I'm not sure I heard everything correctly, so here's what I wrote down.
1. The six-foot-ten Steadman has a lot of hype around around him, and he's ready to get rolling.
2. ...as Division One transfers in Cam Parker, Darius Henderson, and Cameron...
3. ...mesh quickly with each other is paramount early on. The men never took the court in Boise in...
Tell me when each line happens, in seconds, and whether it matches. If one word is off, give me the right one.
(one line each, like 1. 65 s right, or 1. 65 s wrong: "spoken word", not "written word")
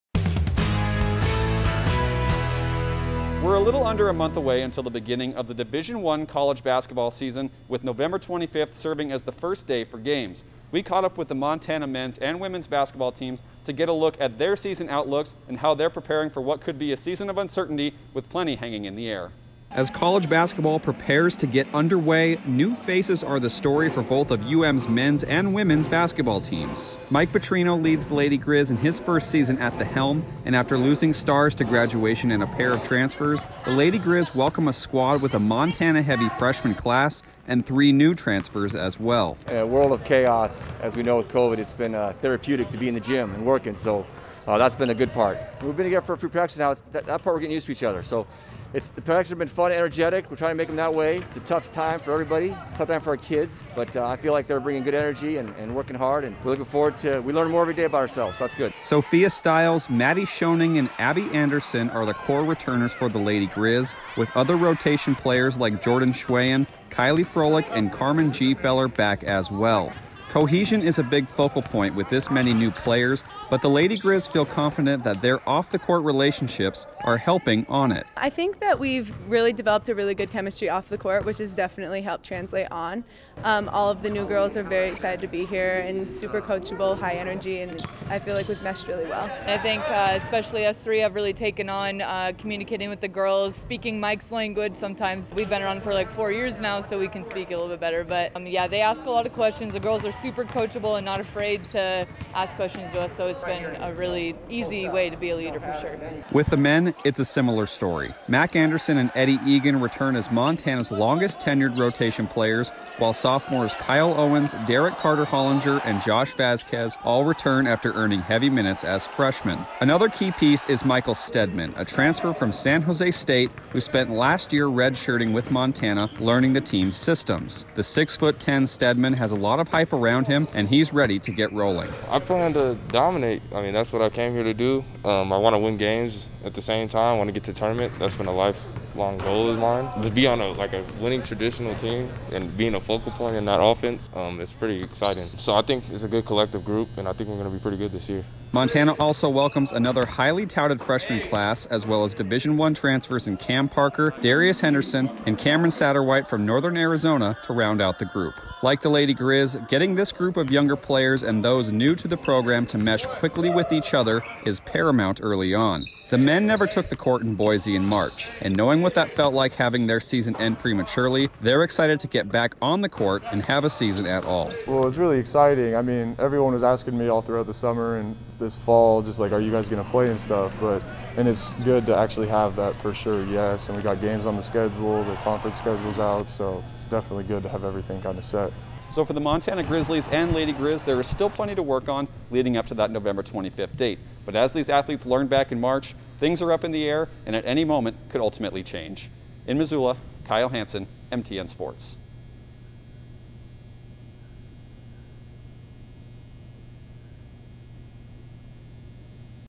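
1. 127 s right
2. 152 s right
3. 162 s right.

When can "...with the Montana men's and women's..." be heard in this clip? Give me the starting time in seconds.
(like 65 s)
11 s.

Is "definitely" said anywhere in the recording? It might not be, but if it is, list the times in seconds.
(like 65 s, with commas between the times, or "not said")
81 s, 186 s.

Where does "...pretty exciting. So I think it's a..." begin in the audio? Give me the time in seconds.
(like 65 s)
144 s.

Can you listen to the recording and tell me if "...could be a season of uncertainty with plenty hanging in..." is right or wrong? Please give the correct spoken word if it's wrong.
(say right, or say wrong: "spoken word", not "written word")
right.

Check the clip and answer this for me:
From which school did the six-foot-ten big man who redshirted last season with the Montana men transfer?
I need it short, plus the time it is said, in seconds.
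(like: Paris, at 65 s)
San Jose State, at 122 s.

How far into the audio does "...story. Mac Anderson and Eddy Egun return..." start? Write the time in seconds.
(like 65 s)
107 s.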